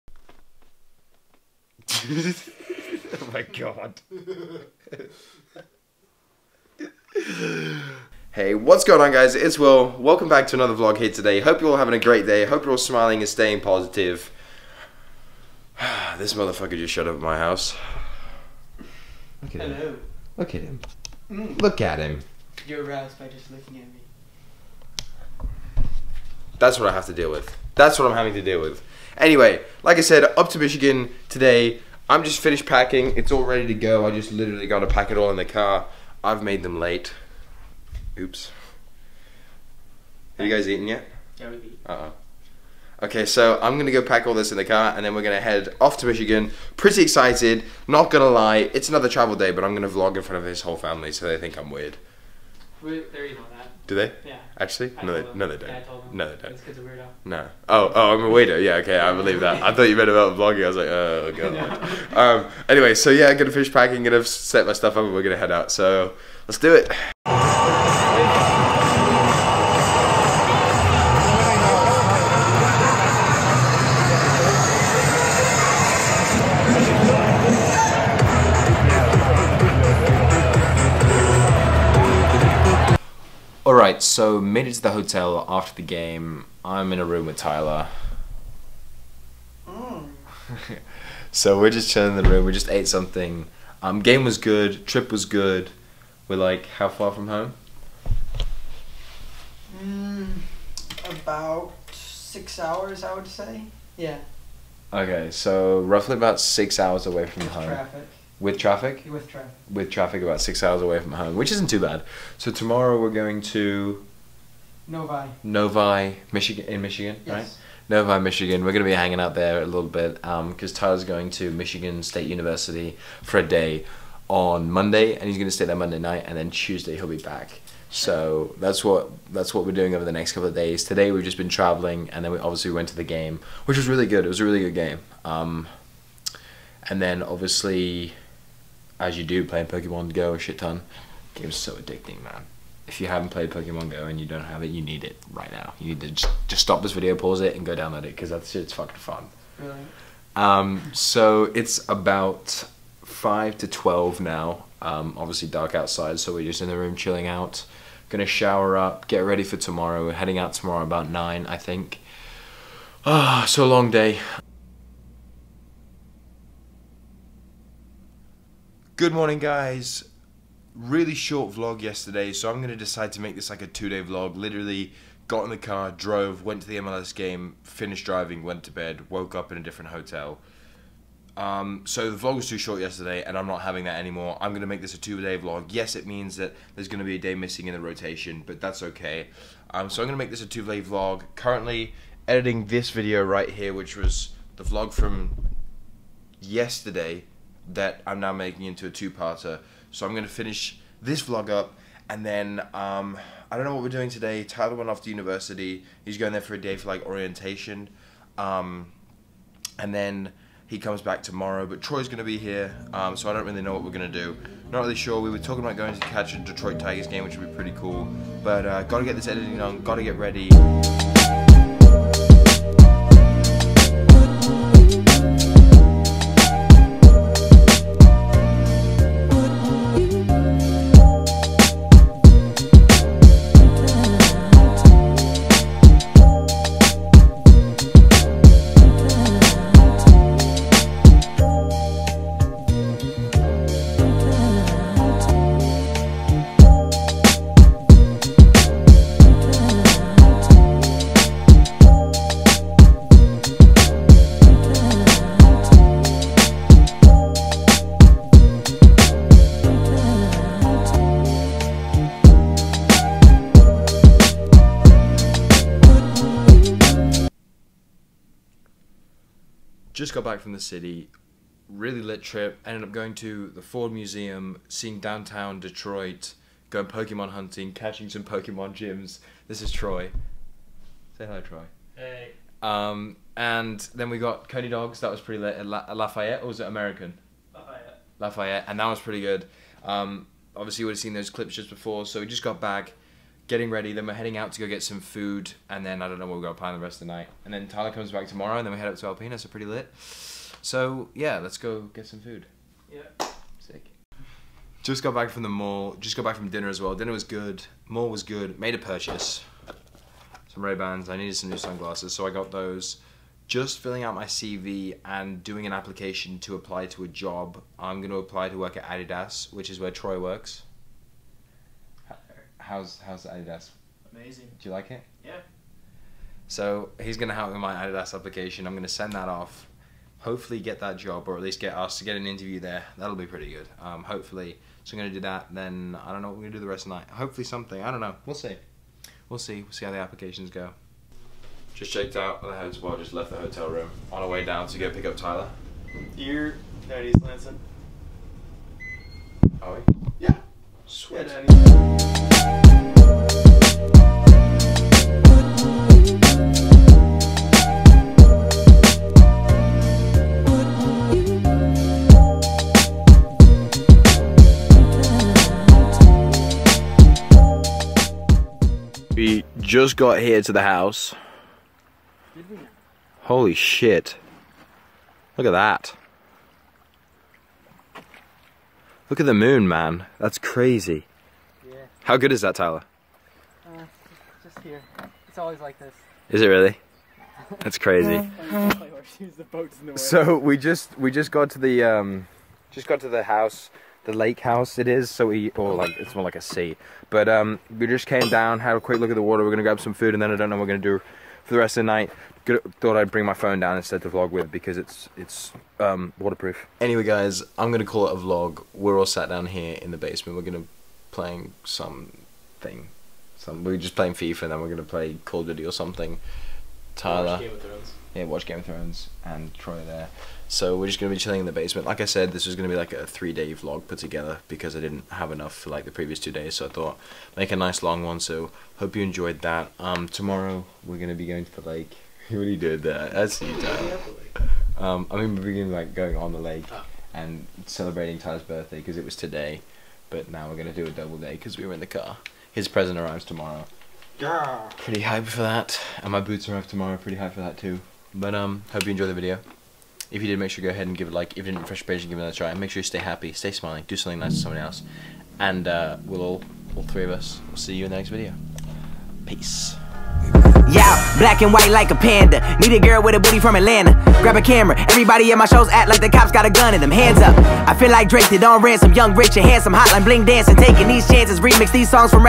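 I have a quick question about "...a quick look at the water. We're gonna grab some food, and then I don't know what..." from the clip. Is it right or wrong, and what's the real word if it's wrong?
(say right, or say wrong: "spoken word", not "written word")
right.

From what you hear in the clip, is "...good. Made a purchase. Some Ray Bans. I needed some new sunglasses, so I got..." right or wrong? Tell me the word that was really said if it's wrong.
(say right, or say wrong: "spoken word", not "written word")
right.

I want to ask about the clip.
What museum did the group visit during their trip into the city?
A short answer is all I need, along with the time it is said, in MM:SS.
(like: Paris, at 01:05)
Ford Museum, at 04:33.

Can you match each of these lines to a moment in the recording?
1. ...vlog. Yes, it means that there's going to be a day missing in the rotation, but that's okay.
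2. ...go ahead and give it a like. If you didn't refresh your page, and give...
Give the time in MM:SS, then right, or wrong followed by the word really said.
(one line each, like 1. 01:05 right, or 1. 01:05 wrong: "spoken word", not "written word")
1. 03:05 right
2. 07:30 right.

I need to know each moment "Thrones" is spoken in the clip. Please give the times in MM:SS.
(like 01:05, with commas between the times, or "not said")
06:58.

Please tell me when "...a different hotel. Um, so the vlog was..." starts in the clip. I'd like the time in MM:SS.
02:59.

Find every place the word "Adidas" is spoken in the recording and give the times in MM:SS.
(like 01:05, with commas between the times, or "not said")
05:18, 05:23, 05:27.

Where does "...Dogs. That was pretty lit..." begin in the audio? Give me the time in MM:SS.
04:44.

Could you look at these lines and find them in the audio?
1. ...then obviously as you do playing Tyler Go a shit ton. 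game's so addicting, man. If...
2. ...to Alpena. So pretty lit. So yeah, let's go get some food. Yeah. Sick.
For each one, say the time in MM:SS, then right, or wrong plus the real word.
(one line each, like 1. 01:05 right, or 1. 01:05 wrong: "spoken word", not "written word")
1. 02:17 wrong: "Pokemon", not "Tyler"
2. 04:58 right.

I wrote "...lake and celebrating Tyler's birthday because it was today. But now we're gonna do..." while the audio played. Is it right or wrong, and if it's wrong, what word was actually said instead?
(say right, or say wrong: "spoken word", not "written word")
right.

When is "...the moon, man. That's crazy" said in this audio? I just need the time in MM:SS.
06:19.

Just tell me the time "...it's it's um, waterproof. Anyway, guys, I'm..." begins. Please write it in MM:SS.
06:44.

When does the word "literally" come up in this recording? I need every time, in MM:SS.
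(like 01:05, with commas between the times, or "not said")
00:34, 02:54.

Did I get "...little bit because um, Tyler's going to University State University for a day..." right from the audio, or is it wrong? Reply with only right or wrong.
wrong.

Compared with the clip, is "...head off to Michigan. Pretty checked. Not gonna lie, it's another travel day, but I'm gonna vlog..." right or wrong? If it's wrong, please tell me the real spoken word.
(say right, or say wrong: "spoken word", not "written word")
wrong: "excited", not "checked".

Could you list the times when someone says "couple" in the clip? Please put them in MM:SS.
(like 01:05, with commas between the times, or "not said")
02:10.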